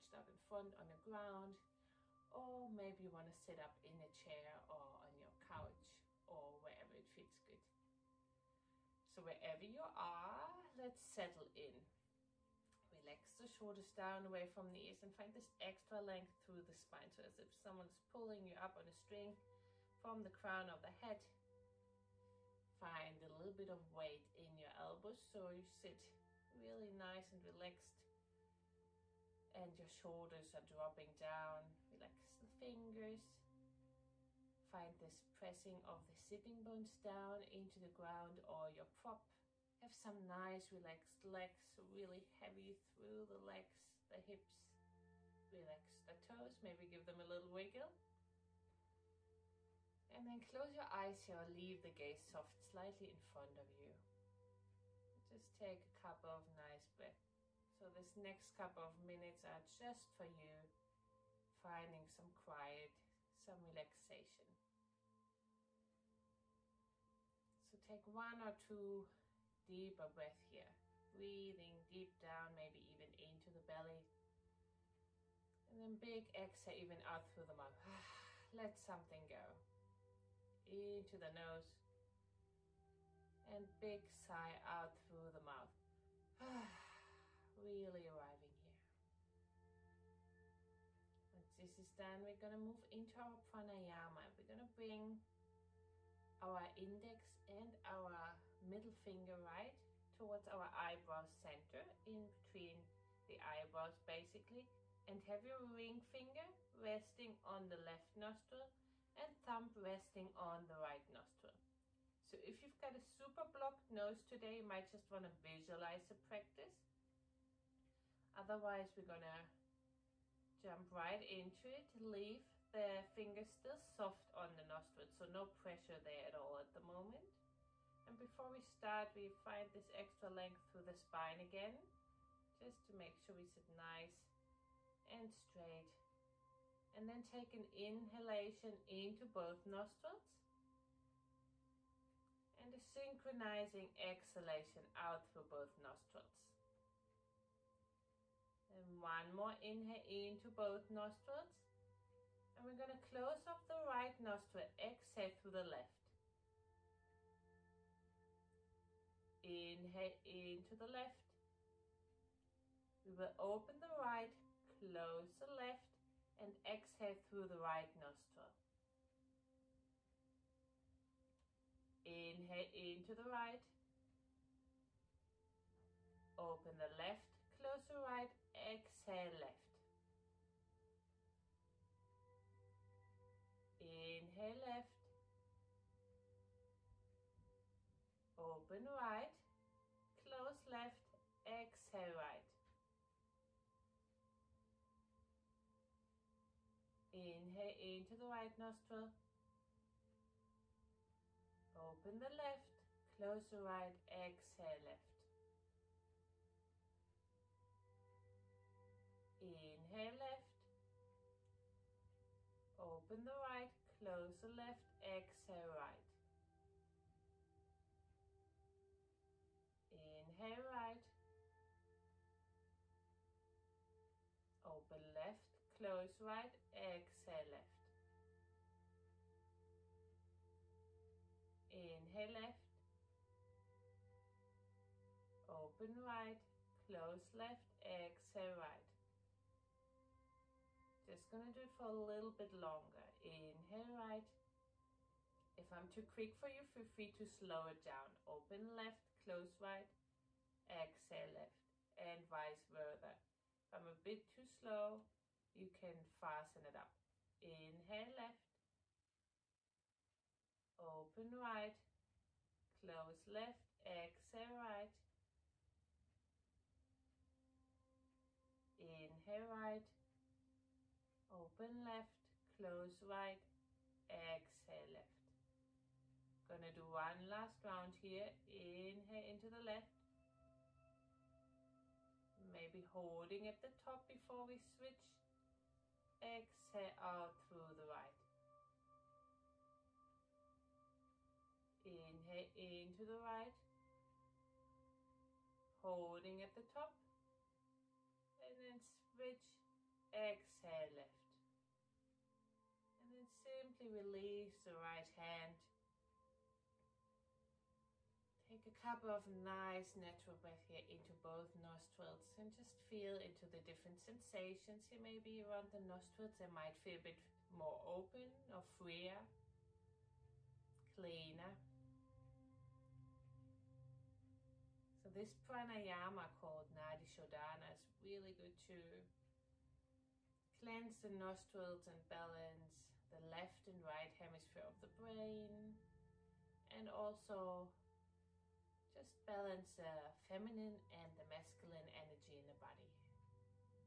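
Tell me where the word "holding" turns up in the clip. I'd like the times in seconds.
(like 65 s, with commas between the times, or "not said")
282 s, 295 s.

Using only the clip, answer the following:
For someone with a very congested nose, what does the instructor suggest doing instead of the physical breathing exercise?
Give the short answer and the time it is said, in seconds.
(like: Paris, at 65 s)
Visualize the practice, at 115 s.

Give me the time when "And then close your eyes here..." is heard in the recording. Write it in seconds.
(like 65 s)
50 s.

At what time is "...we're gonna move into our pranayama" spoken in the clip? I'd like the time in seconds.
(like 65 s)
92 s.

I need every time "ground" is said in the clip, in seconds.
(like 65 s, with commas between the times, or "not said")
0 s, 37 s.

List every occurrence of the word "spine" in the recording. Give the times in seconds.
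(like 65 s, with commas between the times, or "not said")
16 s, 130 s.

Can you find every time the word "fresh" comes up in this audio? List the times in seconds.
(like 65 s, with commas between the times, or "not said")
not said.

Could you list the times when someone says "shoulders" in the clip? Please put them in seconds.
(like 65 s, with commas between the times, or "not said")
13 s, 29 s.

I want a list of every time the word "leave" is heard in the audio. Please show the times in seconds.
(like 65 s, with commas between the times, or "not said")
51 s, 122 s.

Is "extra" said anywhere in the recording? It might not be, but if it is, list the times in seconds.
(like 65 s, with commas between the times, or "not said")
15 s, 129 s.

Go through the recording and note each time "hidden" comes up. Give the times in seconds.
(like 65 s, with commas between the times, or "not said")
not said.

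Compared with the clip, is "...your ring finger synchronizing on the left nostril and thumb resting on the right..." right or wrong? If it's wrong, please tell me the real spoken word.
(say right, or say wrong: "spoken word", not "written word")
wrong: "resting", not "synchronizing".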